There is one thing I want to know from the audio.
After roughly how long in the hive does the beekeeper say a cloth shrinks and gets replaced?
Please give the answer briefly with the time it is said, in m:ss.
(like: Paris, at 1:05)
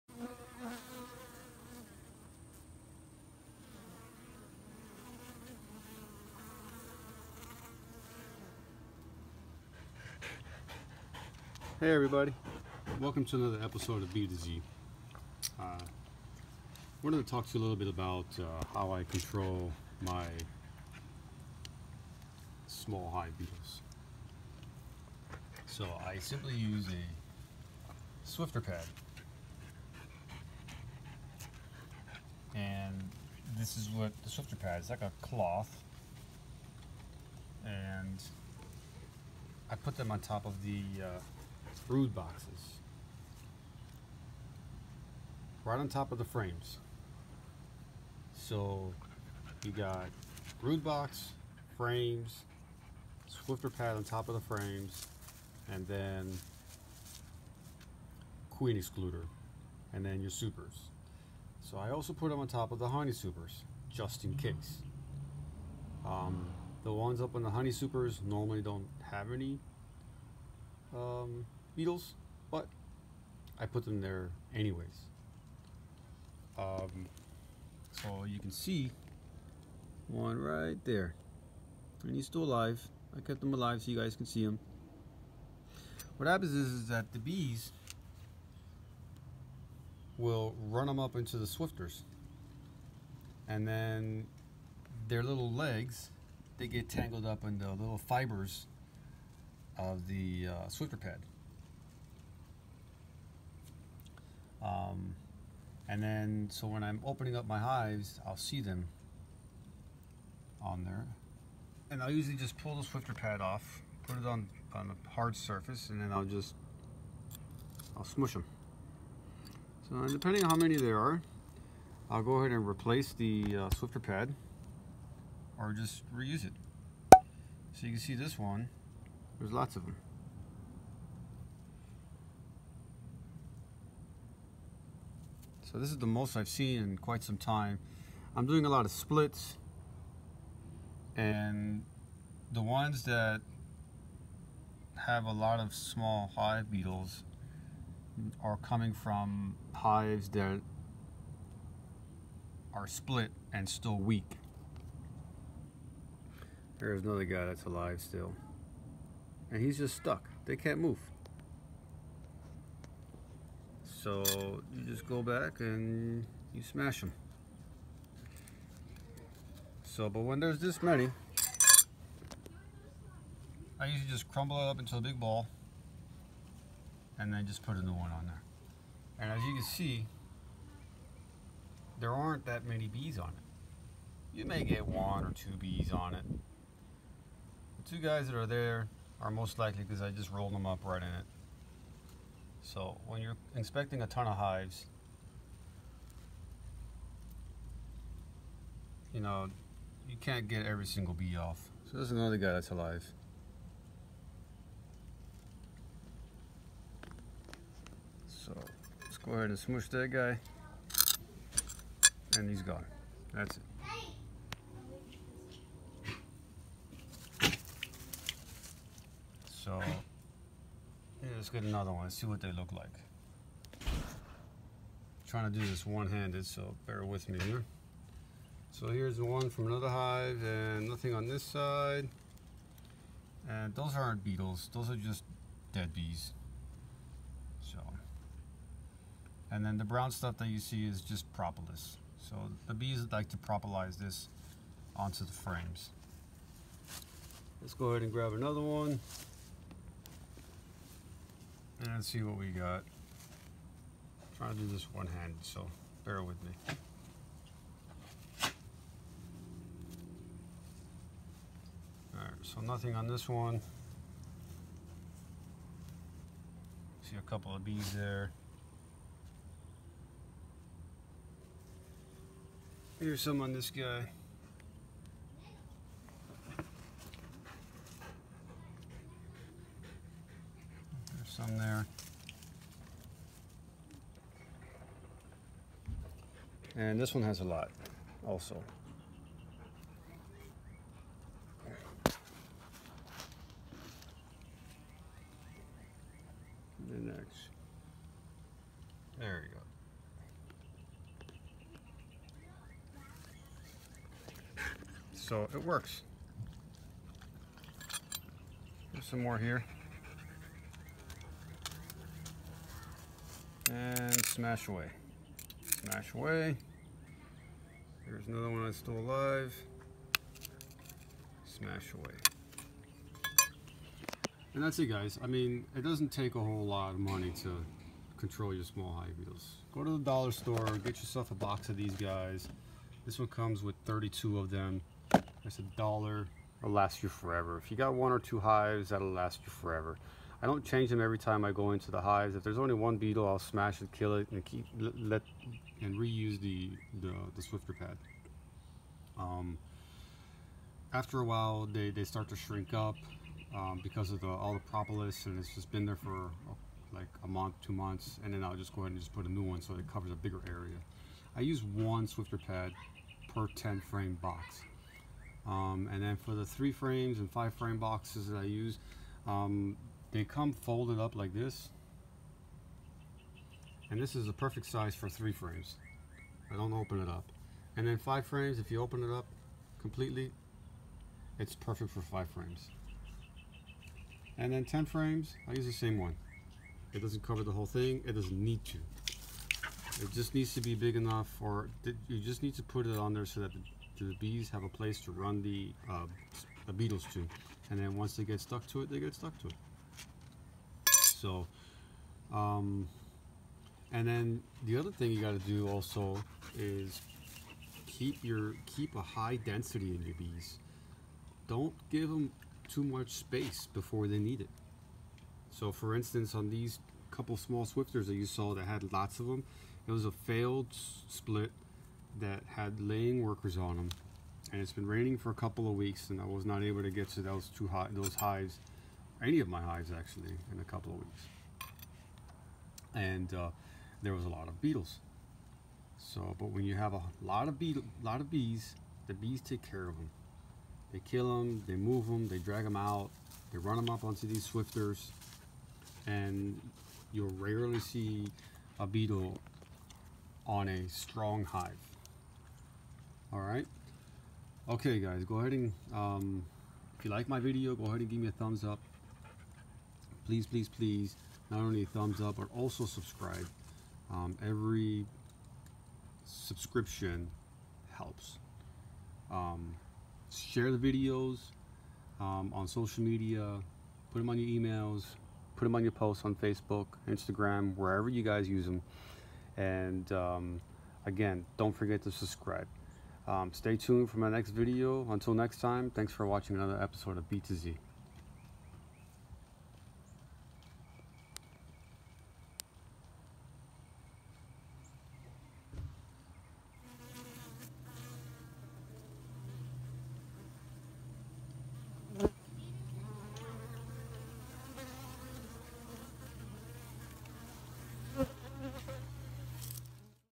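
A month, two months, at 5:57.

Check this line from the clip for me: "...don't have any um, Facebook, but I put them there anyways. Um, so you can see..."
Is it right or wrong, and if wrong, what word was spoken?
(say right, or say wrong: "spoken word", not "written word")
wrong: "Beetles", not "Facebook".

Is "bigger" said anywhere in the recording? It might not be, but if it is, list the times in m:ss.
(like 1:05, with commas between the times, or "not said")
6:00.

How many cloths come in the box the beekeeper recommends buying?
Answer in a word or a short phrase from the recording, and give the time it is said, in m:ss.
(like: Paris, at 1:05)
32, at 5:33.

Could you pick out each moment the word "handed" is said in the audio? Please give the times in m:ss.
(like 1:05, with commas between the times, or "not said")
3:45, 4:14.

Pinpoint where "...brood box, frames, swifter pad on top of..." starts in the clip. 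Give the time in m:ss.
0:50.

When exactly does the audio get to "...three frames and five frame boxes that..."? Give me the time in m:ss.
6:06.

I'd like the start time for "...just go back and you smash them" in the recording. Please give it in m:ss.
2:44.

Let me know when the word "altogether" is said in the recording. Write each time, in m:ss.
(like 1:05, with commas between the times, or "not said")
not said.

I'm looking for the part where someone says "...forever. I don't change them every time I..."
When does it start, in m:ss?
5:39.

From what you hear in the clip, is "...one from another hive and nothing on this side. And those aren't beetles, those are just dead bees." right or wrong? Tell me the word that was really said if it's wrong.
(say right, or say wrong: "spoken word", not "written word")
right.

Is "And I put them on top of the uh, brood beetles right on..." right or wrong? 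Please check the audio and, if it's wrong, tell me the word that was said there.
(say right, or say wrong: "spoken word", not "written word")
wrong: "boxes", not "beetles".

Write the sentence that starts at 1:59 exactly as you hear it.
So depending on how many there are, I'll go ahead and replace the uh, swifter pad or just reuse it.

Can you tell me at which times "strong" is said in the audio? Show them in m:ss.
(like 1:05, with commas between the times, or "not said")
7:30.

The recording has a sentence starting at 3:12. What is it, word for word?
So when you're inspecting a ton of hives, you know, you can't get every single bee off.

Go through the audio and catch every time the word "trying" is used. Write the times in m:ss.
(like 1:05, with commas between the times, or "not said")
3:45, 4:14.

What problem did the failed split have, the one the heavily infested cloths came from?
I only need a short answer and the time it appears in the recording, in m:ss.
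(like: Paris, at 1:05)
Laying workers, at 7:02.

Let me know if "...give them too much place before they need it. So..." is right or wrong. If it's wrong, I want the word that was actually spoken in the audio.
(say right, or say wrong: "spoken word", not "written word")
wrong: "space", not "place".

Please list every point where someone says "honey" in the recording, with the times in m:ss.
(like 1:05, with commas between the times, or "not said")
1:02, 1:07.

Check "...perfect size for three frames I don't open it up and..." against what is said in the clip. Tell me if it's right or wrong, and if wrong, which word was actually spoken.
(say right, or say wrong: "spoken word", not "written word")
right.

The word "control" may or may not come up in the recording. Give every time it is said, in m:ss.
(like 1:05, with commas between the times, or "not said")
0:19, 5:28.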